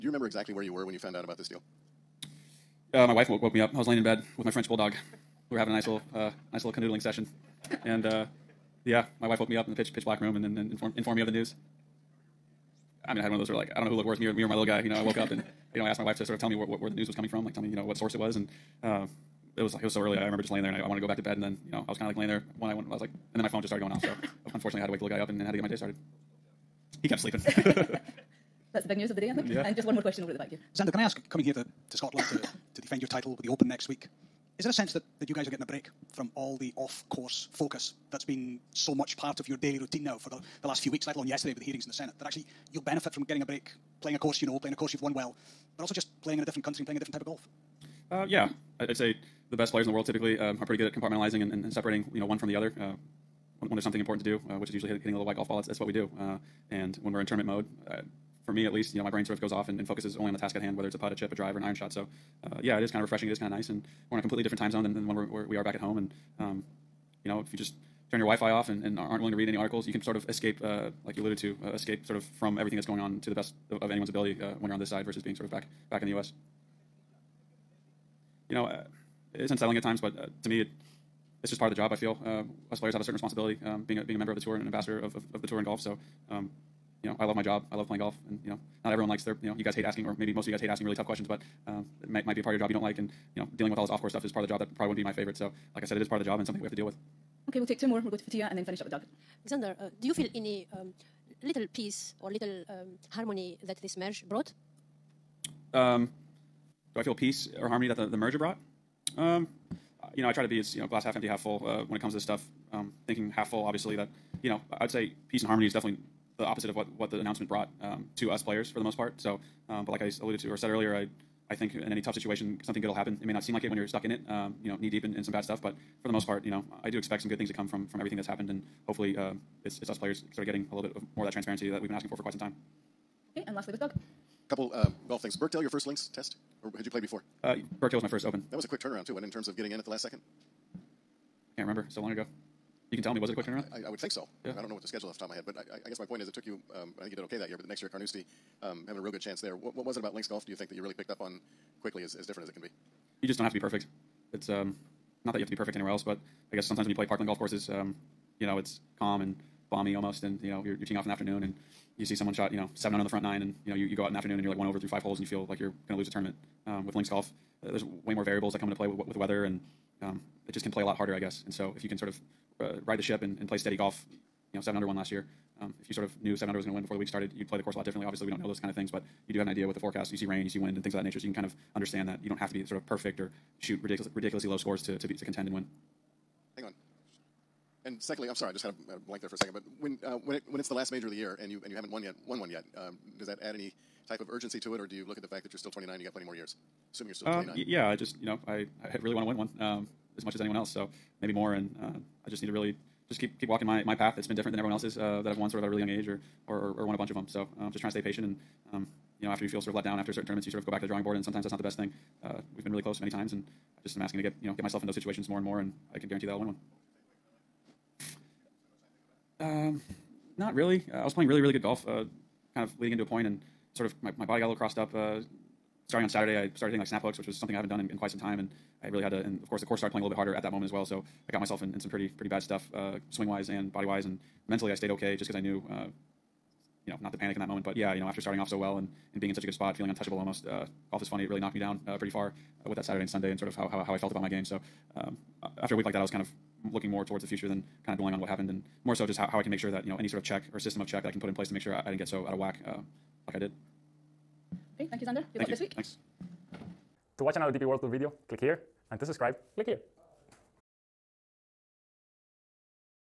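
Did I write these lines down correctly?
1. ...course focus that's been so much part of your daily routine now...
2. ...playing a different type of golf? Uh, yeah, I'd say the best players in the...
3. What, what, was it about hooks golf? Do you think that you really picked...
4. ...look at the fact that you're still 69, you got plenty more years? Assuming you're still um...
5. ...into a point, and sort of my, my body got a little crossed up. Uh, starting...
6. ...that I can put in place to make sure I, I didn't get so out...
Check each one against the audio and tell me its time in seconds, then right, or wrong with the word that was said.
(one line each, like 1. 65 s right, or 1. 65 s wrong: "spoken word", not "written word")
1. 37 s right
2. 46 s right
3. 149 s wrong: "links", not "hooks"
4. 195 s wrong: "29", not "69"
5. 222 s right
6. 251 s right.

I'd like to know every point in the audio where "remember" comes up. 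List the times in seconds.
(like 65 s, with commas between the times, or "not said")
0 s, 20 s, 141 s.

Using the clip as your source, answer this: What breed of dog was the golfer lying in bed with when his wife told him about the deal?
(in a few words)
French bulldog.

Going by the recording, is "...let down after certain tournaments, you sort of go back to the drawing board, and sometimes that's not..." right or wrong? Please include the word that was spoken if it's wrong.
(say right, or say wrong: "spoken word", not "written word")
right.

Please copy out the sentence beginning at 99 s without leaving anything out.
Alexander, uh, do you feel any um, little peace or little um, harmony that this merge brought?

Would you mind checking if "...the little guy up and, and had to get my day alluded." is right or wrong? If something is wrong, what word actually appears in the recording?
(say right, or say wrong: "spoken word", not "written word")
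wrong: "started", not "alluded".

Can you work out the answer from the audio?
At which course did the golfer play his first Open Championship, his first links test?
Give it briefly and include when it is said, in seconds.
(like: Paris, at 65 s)
Birkdale, at 135 s.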